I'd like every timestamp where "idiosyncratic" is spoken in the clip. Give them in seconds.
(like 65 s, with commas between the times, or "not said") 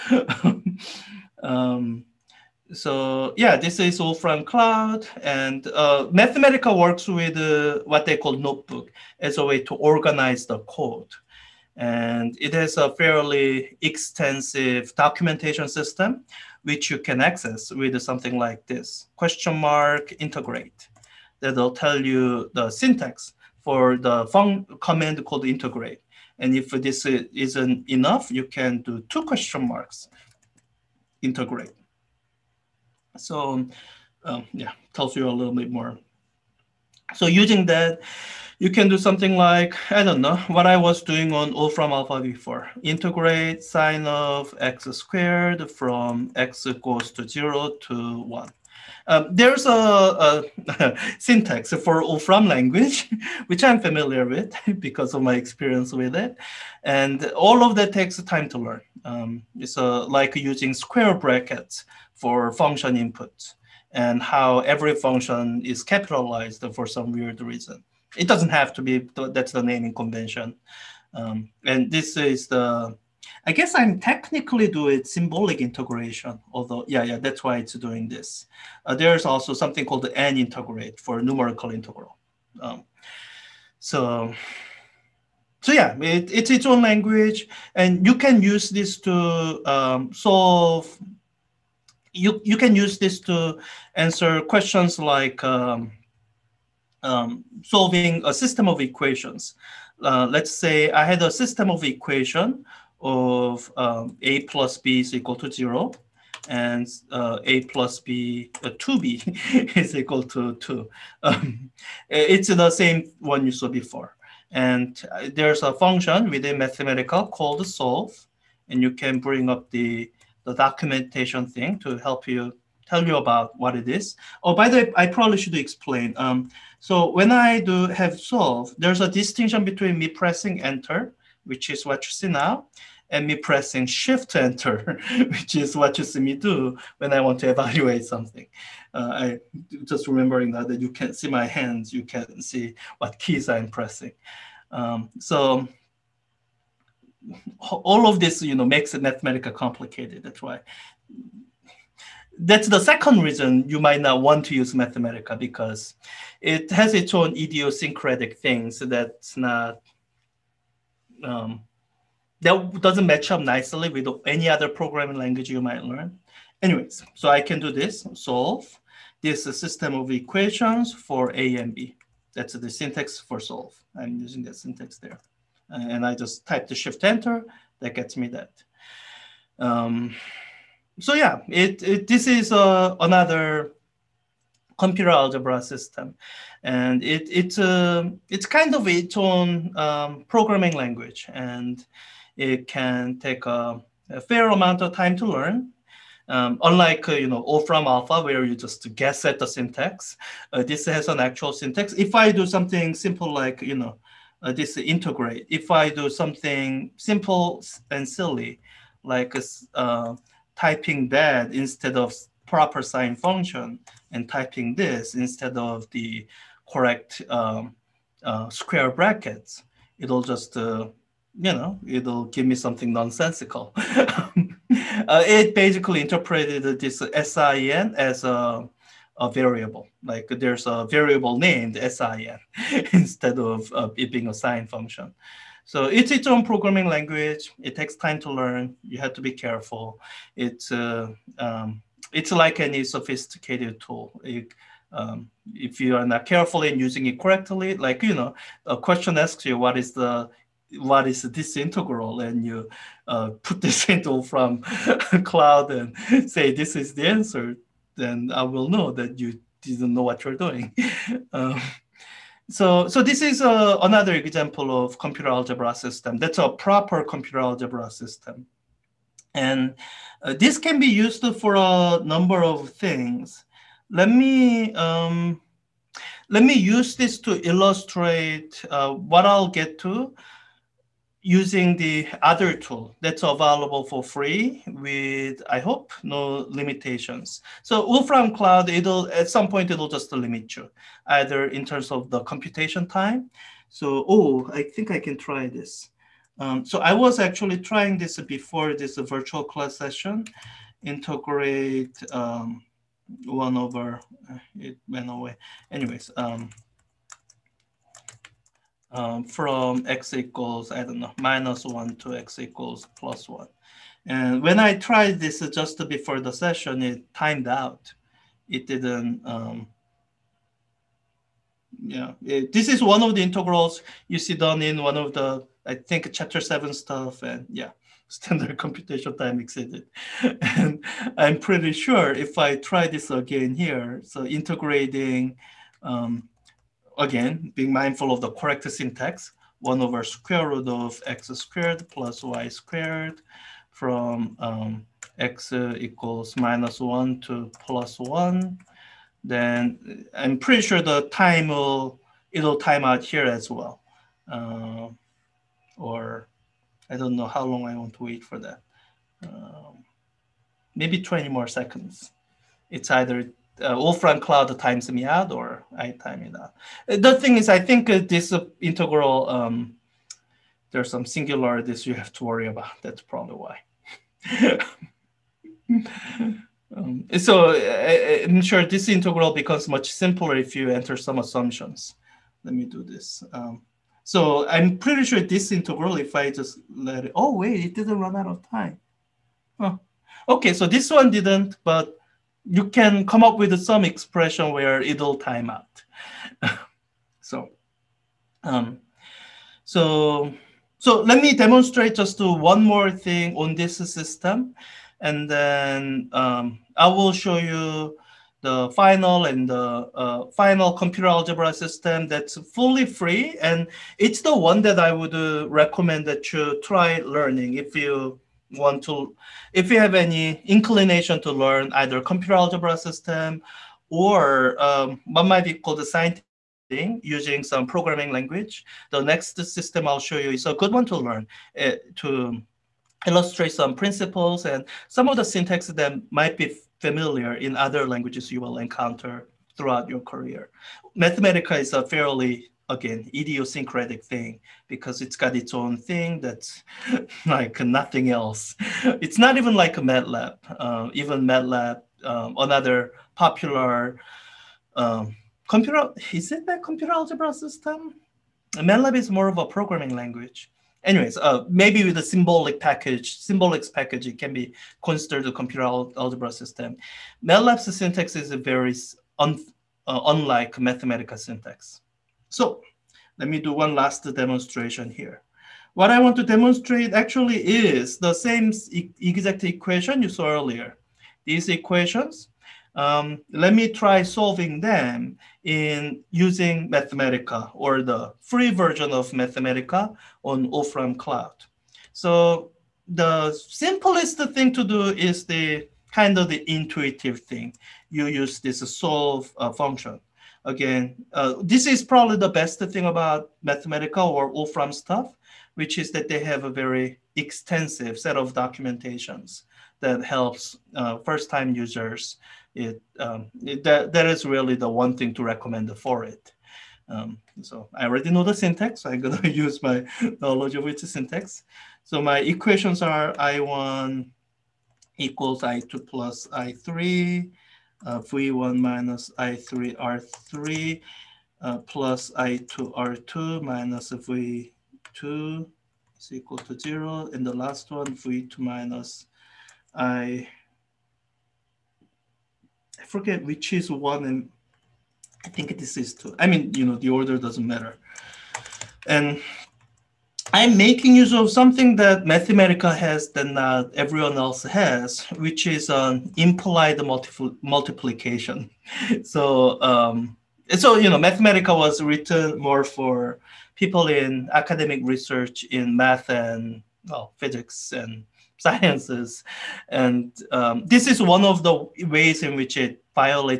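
157 s, 443 s.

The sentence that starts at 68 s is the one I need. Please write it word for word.
It doesn't have to be, that's the naming convention.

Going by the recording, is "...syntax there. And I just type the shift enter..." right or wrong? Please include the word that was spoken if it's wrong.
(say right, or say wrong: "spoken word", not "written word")
right.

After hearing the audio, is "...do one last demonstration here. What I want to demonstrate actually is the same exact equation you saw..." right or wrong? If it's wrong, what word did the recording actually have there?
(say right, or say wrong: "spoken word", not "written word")
right.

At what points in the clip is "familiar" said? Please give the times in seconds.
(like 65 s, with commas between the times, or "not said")
53 s, 436 s.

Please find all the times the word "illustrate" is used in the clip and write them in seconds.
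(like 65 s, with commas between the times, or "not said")
277 s, 433 s.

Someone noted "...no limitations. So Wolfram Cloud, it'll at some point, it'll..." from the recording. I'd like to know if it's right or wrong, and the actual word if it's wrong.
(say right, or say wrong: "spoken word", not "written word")
right.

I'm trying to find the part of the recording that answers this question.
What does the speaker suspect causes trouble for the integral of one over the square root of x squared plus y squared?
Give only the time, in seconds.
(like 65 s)
371 s.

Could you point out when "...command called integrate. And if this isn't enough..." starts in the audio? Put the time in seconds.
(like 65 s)
24 s.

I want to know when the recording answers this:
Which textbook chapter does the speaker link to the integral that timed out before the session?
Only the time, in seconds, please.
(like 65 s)
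326 s.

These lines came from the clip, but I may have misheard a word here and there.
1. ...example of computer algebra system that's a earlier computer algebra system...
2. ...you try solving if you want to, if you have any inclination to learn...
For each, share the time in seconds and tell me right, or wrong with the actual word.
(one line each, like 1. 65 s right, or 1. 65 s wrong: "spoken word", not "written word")
1. 264 s wrong: "proper", not "earlier"
2. 416 s wrong: "learning", not "solving".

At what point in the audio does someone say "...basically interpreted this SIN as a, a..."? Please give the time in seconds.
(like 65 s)
225 s.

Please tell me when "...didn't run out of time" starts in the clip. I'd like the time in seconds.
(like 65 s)
387 s.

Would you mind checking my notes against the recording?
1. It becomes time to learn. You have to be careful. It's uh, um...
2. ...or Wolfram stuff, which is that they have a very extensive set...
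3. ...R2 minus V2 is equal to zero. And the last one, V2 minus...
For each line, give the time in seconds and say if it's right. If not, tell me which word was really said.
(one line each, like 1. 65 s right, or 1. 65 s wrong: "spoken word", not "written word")
1. 237 s wrong: "takes", not "becomes"
2. 504 s right
3. 532 s right.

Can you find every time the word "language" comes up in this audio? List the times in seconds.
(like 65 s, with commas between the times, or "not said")
52 s, 86 s, 165 s, 190 s, 236 s, 428 s, 437 s, 459 s.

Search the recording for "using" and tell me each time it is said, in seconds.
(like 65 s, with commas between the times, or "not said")
37 s, 60 s, 174 s, 246 s, 281 s, 427 s, 486 s.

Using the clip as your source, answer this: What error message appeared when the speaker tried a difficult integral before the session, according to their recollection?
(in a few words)
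standard computational time exceeded.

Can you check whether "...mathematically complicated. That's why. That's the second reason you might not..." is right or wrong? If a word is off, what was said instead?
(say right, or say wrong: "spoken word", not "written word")
right.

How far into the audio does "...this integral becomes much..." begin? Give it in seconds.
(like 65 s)
378 s.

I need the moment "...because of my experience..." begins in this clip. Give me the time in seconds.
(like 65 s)
54 s.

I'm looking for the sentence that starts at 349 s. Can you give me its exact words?
Then I'm pretty sure the time will, it'll time out here as well.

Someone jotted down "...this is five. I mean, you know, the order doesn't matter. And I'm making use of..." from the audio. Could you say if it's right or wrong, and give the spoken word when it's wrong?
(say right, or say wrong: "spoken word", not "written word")
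wrong: "two", not "five".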